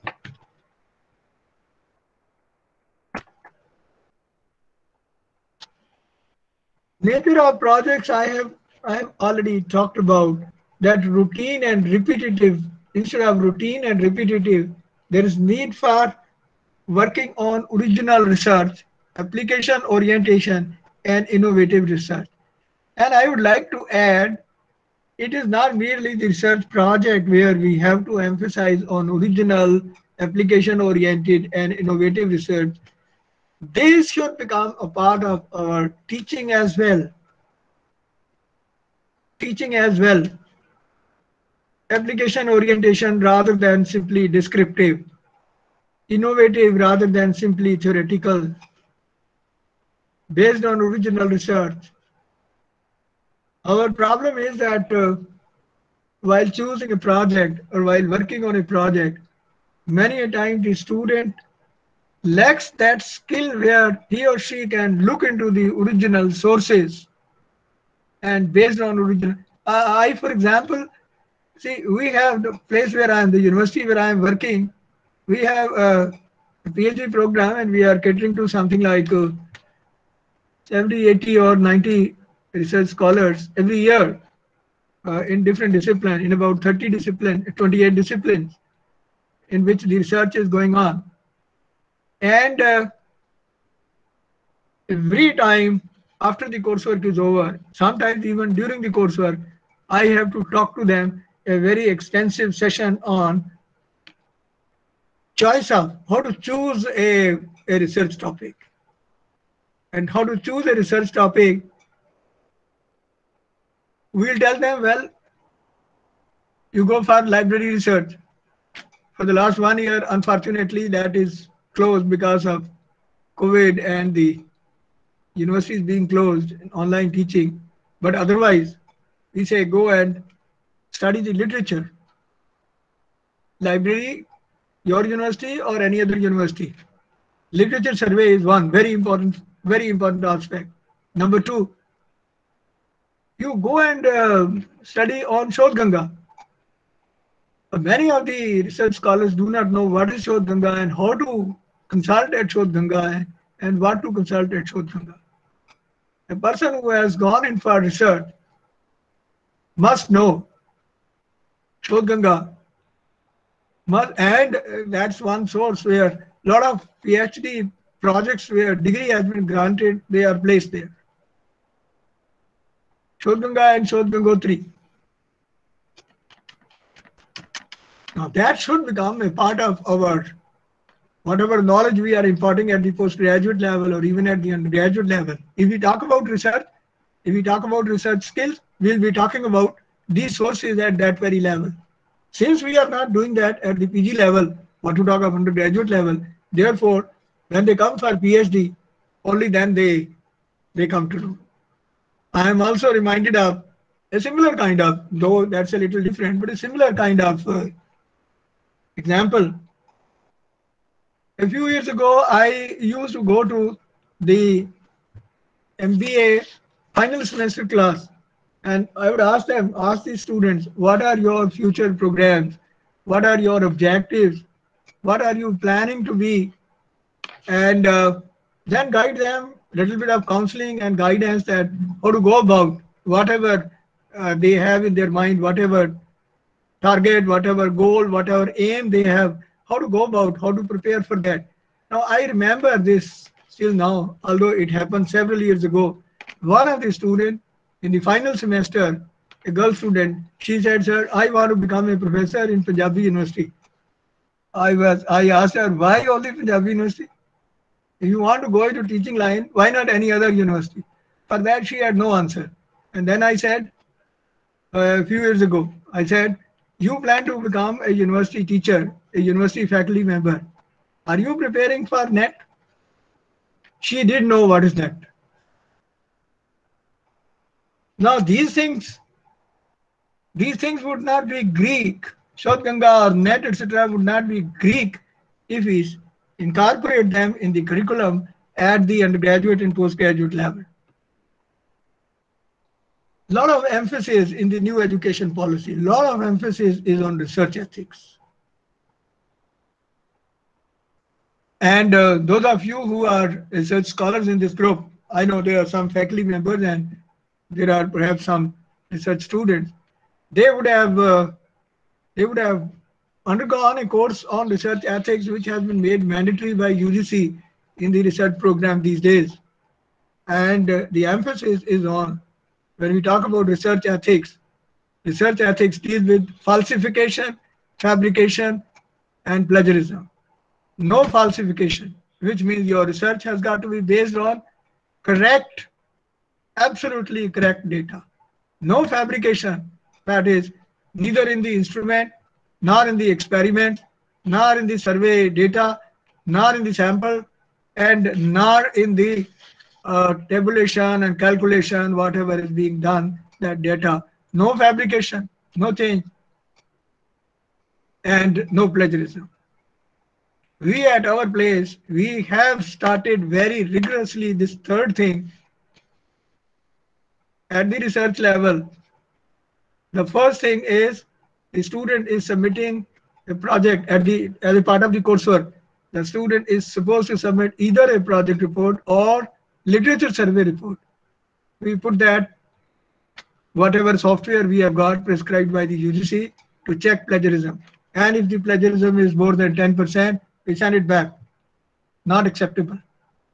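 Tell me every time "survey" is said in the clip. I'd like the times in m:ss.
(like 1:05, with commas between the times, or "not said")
2:17, 5:44, 6:20.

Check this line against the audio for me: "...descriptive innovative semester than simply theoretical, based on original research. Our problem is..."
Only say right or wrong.
wrong.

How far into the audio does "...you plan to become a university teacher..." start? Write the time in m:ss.
4:26.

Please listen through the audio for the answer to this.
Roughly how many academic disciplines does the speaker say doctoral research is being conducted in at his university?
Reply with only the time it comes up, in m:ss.
1:27.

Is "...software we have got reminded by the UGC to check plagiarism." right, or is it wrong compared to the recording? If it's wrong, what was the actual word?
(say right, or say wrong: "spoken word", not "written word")
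wrong: "prescribed", not "reminded".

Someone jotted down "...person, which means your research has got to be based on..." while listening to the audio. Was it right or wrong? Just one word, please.
wrong.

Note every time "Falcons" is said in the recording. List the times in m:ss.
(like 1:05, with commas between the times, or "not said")
not said.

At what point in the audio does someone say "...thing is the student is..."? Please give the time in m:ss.
6:10.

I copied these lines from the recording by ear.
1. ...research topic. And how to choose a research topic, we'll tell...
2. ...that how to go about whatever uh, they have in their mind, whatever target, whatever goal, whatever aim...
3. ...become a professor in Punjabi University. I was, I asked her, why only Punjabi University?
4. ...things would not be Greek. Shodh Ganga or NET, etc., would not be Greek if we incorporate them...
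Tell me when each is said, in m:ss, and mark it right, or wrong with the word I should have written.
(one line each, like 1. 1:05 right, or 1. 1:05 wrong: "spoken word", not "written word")
1. 1:47 right
2. 3:51 right
3. 4:11 right
4. 4:40 right.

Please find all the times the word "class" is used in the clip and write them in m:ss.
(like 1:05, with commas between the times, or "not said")
3:37.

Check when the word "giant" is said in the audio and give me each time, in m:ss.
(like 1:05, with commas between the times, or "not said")
not said.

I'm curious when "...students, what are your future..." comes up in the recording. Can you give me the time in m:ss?
3:40.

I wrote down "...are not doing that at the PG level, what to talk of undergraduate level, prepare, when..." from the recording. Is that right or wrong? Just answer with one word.
wrong.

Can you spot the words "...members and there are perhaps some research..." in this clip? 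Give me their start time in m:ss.
5:06.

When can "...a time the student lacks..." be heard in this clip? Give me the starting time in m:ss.
1:00.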